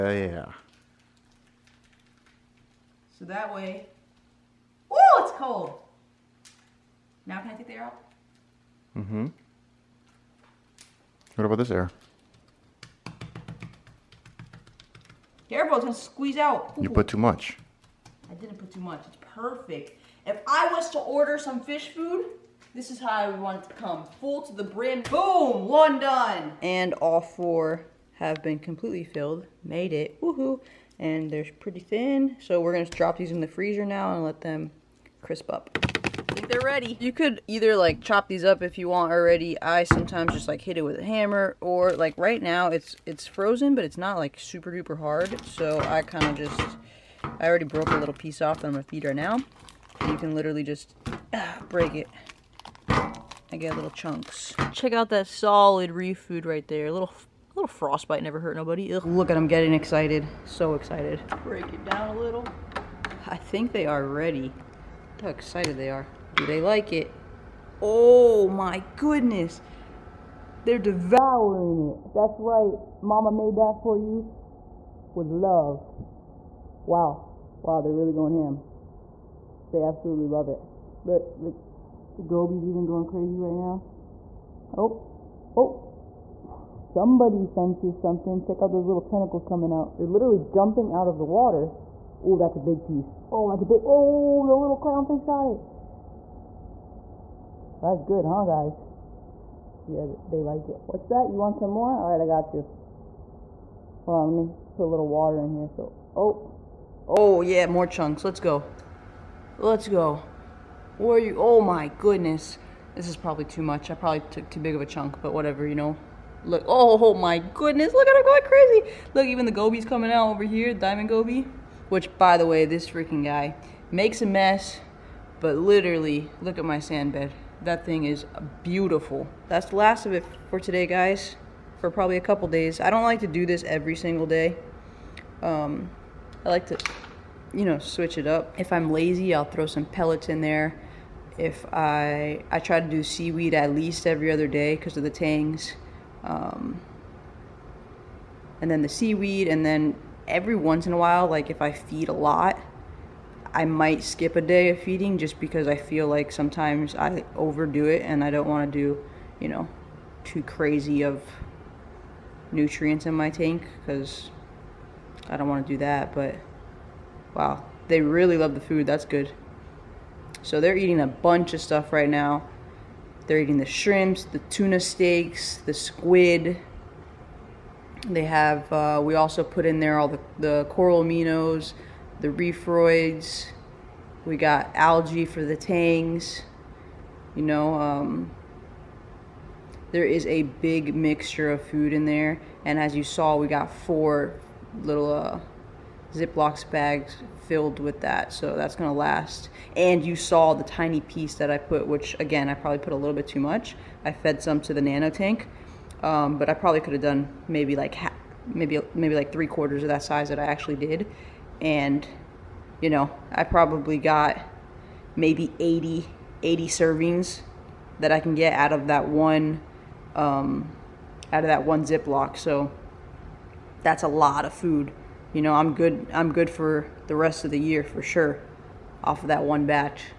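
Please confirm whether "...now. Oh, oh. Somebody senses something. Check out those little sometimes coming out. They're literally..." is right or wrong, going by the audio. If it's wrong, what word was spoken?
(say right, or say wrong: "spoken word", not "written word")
wrong: "tentacles", not "sometimes".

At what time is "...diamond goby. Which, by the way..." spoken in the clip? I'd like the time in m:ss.
2:00.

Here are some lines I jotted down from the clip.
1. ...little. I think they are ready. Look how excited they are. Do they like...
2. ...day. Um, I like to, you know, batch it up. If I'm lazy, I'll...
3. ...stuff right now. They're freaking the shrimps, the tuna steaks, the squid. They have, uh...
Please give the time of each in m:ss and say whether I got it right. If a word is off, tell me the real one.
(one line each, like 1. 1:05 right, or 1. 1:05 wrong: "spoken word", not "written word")
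1. 1:02 right
2. 2:14 wrong: "switch", not "batch"
3. 2:51 wrong: "eating", not "freaking".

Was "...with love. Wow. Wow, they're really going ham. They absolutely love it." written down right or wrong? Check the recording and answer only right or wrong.
right.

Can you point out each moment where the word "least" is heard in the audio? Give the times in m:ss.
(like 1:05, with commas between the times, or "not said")
2:23.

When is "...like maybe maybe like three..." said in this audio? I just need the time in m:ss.
3:27.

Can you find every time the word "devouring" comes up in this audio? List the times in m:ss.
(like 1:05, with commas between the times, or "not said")
1:10.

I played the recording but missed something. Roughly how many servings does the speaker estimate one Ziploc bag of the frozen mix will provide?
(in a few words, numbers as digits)
80.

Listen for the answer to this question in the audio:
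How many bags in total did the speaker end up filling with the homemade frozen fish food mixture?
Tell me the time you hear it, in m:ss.
0:26.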